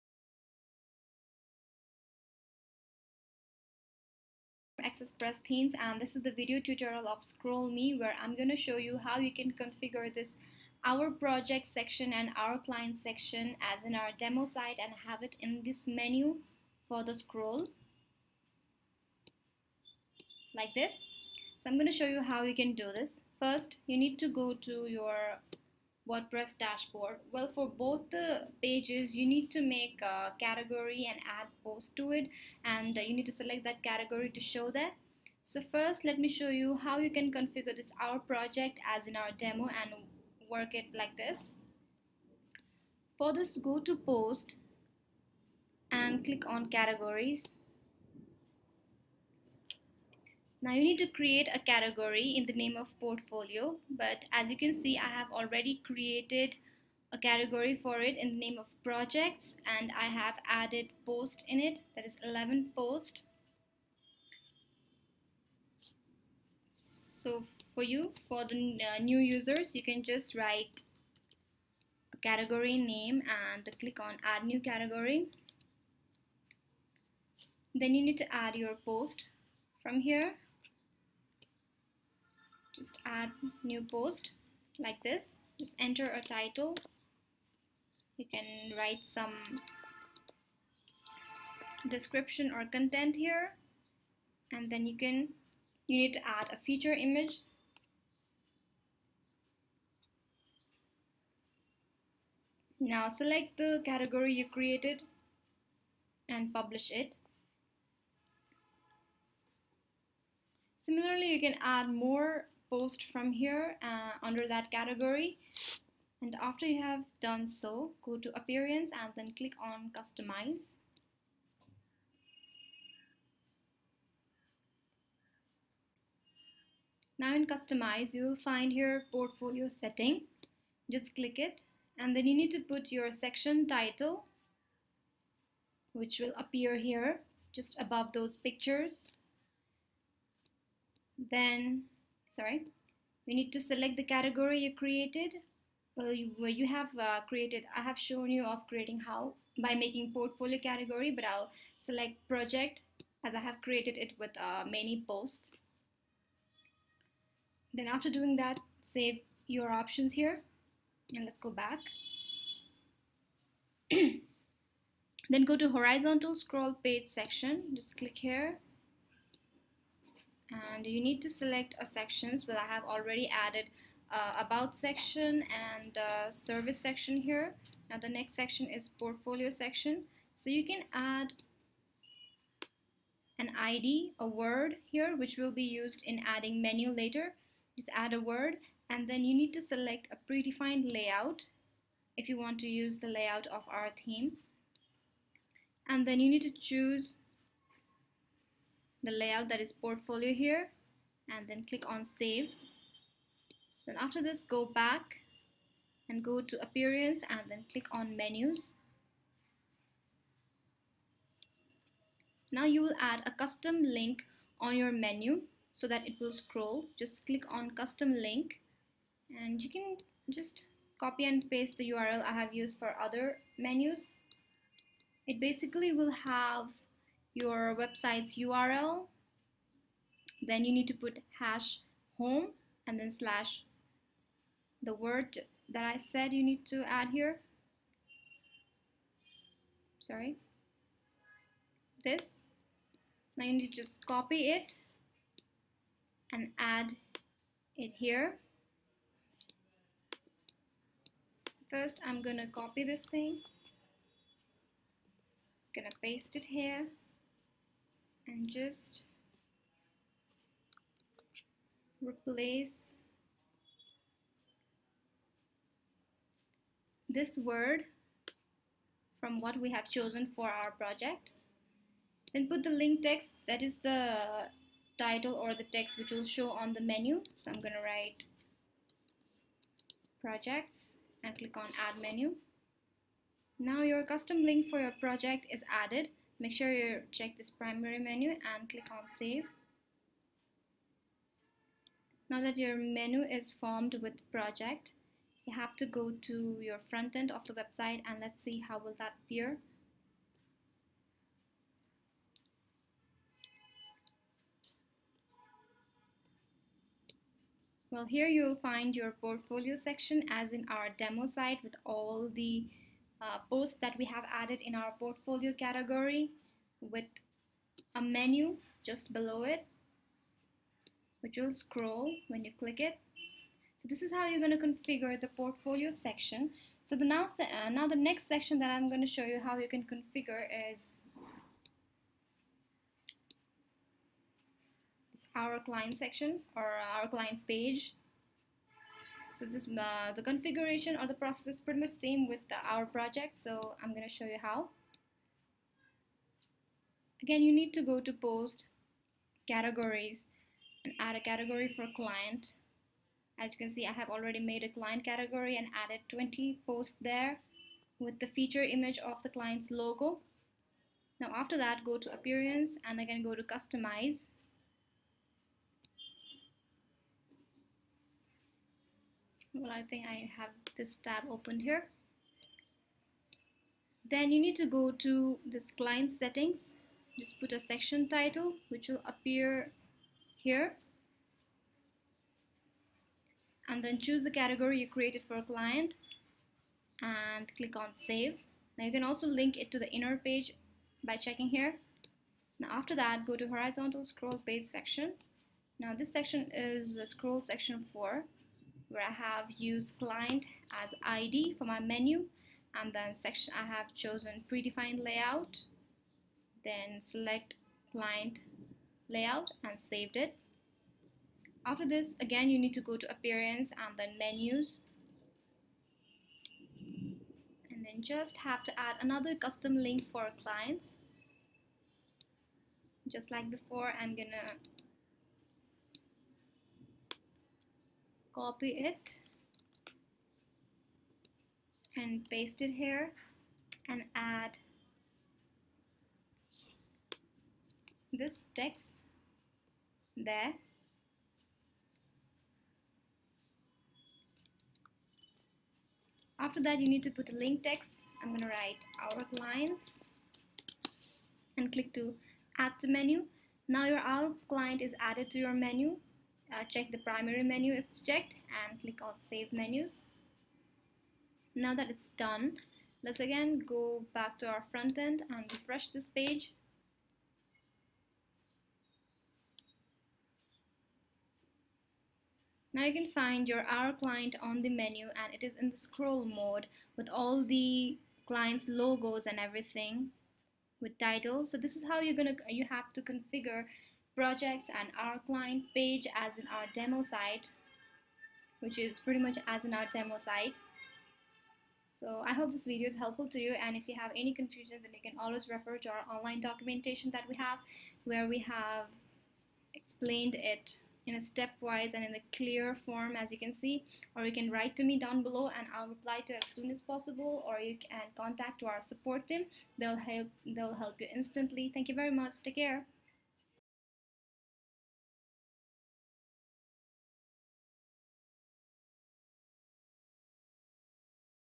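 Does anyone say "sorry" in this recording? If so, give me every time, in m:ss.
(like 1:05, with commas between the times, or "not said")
2:22, 3:59.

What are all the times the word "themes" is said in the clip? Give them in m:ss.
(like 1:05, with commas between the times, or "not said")
0:05, 3:14.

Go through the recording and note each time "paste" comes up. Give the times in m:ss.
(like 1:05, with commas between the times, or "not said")
3:41, 4:16, 7:12.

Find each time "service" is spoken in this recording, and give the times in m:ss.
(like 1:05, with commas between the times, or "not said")
2:56.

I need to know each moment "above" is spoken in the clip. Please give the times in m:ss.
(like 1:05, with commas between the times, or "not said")
2:17.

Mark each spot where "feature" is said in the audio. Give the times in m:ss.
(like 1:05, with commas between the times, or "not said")
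1:36, 5:58.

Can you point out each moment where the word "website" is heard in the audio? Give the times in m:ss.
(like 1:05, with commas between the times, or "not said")
3:47, 4:57.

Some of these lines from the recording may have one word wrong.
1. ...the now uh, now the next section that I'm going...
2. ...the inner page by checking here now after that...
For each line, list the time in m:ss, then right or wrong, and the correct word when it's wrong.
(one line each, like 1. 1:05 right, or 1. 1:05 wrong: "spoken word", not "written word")
1. 5:26 right
2. 6:29 right.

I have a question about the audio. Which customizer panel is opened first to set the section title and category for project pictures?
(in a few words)
portfolio setting.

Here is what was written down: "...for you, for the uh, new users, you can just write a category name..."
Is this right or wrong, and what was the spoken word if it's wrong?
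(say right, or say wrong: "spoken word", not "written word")
right.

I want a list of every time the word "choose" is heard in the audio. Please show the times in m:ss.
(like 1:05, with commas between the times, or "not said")
3:16, 6:23.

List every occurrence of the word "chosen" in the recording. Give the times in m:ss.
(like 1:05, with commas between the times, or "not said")
4:29, 6:43.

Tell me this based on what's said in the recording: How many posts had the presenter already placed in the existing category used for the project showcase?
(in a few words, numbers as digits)
11.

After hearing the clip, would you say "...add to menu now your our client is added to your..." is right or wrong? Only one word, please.
right.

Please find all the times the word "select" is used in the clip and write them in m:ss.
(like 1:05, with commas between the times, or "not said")
0:33, 1:43, 2:23, 2:31, 2:51, 3:09, 6:47.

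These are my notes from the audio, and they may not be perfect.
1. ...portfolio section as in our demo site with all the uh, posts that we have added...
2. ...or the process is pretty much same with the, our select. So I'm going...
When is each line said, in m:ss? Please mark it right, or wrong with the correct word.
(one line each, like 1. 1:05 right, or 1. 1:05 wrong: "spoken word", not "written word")
1. 5:09 right
2. 5:40 wrong: "project", not "select".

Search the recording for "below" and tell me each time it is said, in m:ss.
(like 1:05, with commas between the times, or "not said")
5:19, 8:25.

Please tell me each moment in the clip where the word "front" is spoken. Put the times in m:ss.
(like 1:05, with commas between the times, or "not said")
4:56, 7:44.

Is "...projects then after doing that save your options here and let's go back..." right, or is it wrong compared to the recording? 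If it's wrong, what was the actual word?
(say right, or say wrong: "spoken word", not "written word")
wrong: "posts", not "projects".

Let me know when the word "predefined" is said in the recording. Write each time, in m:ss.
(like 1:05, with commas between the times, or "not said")
3:10, 6:44.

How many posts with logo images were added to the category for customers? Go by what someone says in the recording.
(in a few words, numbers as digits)
20.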